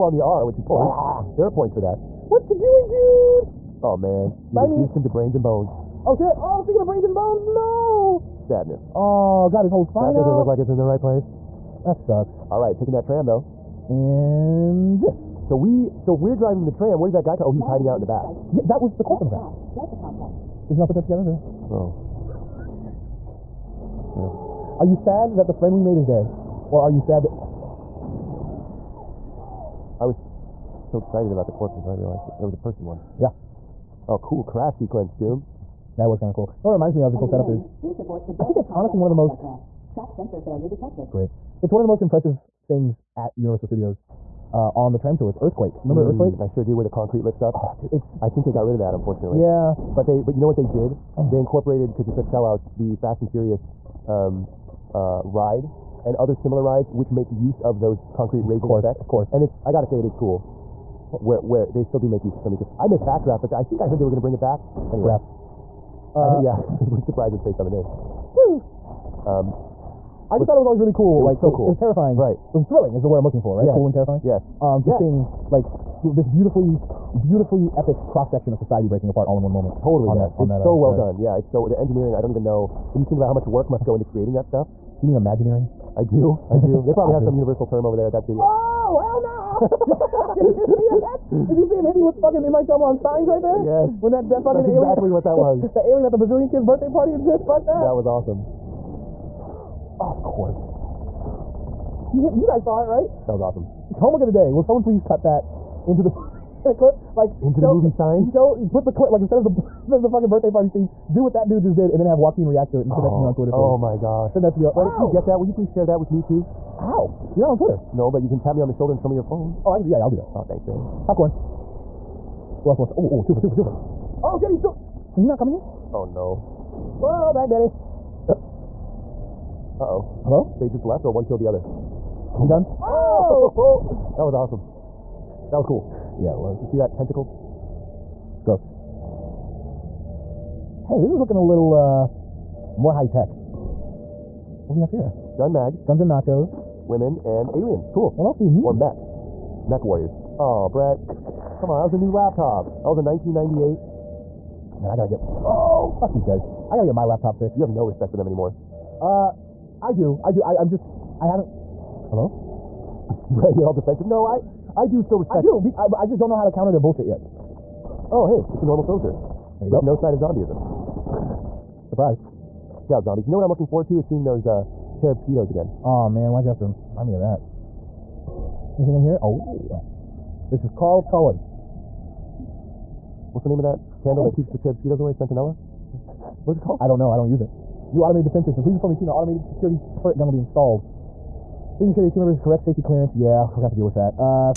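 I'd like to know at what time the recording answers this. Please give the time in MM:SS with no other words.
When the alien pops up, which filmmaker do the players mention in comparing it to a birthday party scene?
01:32.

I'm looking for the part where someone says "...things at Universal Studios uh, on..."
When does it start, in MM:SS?
00:42.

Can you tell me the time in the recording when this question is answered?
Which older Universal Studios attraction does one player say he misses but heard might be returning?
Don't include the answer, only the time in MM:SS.
01:02.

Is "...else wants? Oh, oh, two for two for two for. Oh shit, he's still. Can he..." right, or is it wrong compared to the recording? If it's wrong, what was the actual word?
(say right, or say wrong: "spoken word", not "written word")
right.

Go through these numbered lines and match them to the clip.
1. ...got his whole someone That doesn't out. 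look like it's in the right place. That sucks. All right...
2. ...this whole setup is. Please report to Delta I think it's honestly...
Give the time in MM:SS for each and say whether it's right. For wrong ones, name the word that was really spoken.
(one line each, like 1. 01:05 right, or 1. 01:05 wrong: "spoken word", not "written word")
1. 00:09 wrong: "spine", not "someone"
2. 00:37 right.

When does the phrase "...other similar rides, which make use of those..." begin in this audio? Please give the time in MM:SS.
00:56.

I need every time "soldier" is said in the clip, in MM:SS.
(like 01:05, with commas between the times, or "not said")
02:48.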